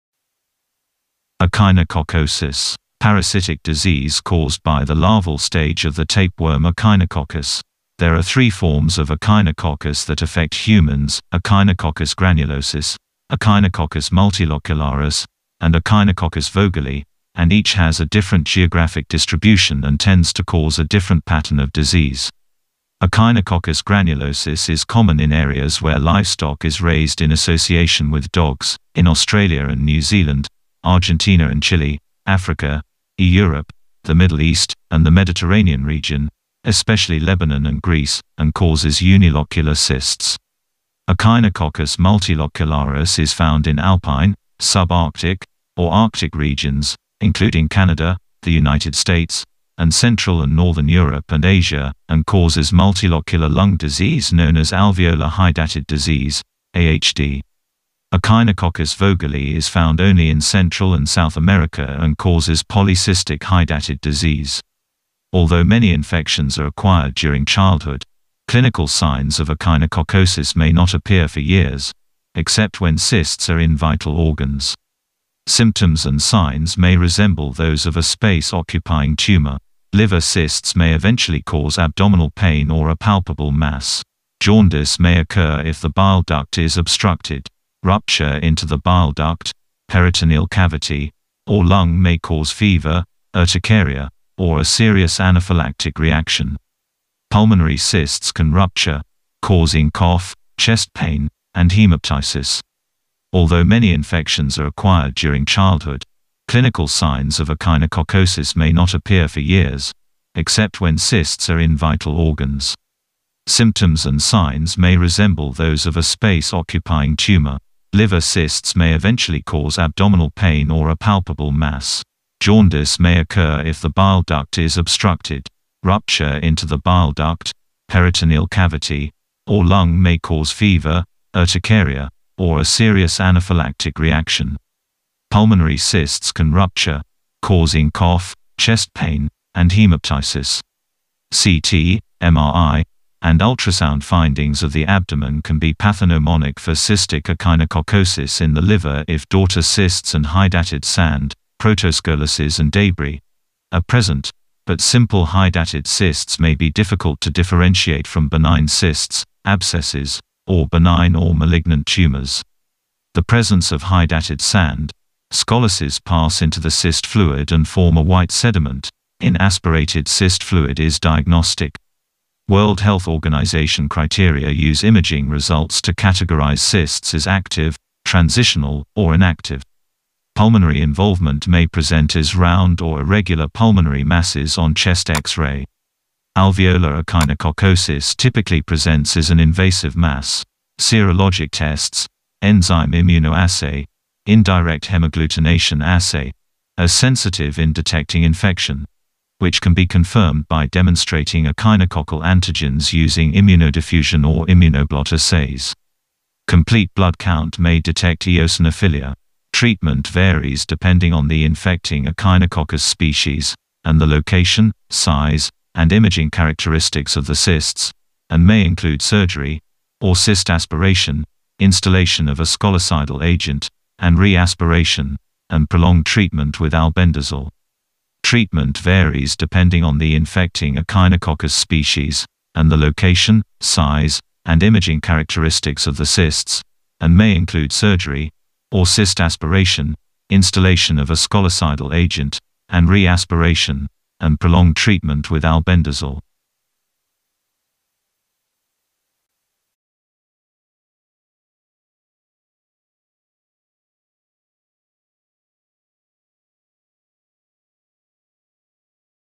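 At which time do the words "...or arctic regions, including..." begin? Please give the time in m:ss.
0:45.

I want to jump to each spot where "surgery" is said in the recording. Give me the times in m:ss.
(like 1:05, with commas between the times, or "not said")
3:39, 3:57.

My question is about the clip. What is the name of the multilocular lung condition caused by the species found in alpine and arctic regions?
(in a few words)
Alveolar hydatid disease.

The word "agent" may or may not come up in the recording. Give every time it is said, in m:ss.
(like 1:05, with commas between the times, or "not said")
3:43, 4:01.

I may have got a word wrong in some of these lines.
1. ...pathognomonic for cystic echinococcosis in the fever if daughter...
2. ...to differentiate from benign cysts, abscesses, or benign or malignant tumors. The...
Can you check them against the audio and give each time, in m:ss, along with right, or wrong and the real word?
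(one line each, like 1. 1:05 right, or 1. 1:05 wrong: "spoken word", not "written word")
1. 2:25 wrong: "liver", not "fever"
2. 2:37 right.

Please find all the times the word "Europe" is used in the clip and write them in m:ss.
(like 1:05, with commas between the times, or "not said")
0:33, 0:50.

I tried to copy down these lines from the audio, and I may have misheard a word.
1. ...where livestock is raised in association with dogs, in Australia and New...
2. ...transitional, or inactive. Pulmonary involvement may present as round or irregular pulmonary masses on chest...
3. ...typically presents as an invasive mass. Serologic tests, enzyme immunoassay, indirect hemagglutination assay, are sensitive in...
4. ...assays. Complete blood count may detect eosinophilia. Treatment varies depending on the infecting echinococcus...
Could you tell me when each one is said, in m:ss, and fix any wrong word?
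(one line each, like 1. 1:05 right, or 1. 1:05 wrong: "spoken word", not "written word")
1. 0:25 right
2. 2:58 right
3. 3:08 right
4. 3:25 right.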